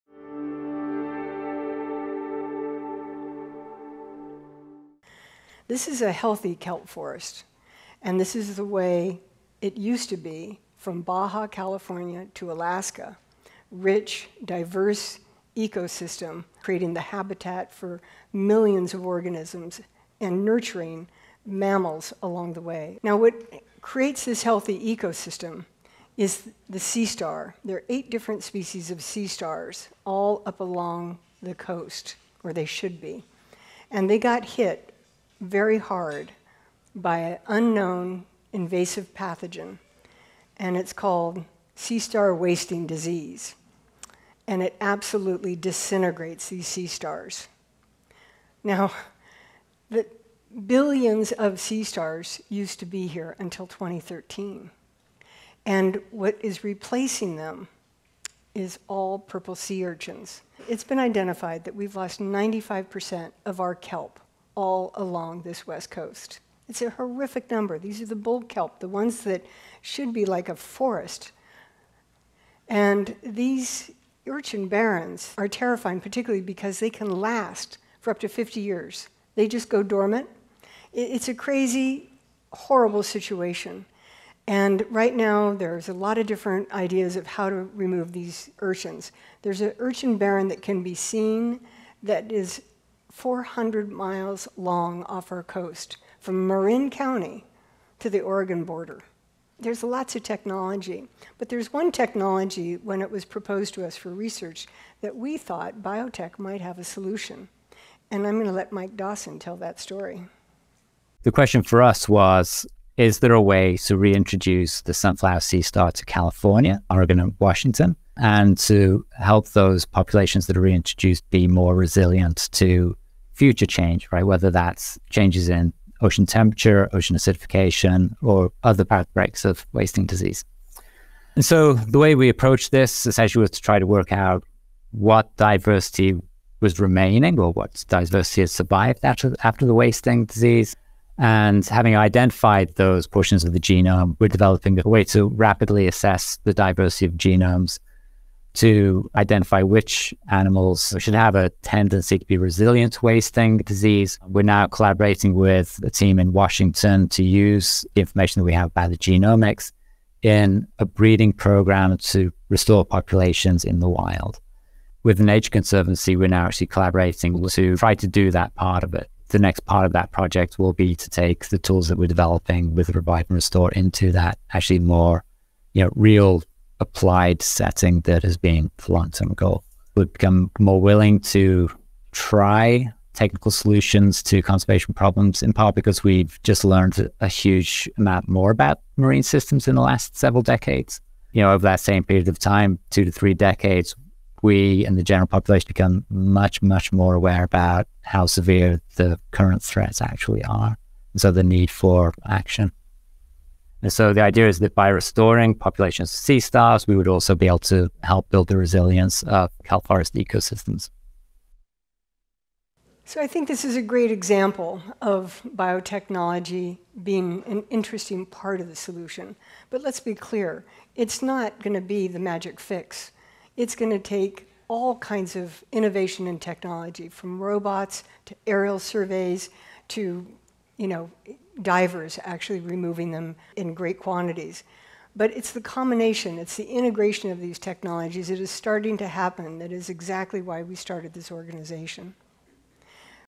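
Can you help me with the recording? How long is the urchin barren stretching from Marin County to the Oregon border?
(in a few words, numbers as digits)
400 miles.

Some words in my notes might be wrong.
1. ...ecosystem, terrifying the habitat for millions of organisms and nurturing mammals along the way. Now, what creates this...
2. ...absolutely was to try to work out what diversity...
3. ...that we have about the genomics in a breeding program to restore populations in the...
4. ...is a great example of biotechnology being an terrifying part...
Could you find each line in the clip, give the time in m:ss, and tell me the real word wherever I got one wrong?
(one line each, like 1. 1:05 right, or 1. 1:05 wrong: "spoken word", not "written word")
1. 0:15 wrong: "creating", not "terrifying"
2. 2:13 wrong: "essentially", not "absolutely"
3. 2:38 right
4. 3:33 wrong: "interesting", not "terrifying".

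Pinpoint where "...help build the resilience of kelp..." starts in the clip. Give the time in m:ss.
3:28.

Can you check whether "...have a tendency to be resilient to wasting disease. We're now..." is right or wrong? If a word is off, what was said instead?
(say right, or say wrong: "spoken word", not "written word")
right.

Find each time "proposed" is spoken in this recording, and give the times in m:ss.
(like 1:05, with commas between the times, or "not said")
1:43.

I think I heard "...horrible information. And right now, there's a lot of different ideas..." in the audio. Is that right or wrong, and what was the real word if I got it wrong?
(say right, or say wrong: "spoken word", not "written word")
wrong: "situation", not "information".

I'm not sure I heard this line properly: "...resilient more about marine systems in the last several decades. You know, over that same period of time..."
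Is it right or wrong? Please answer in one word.
wrong.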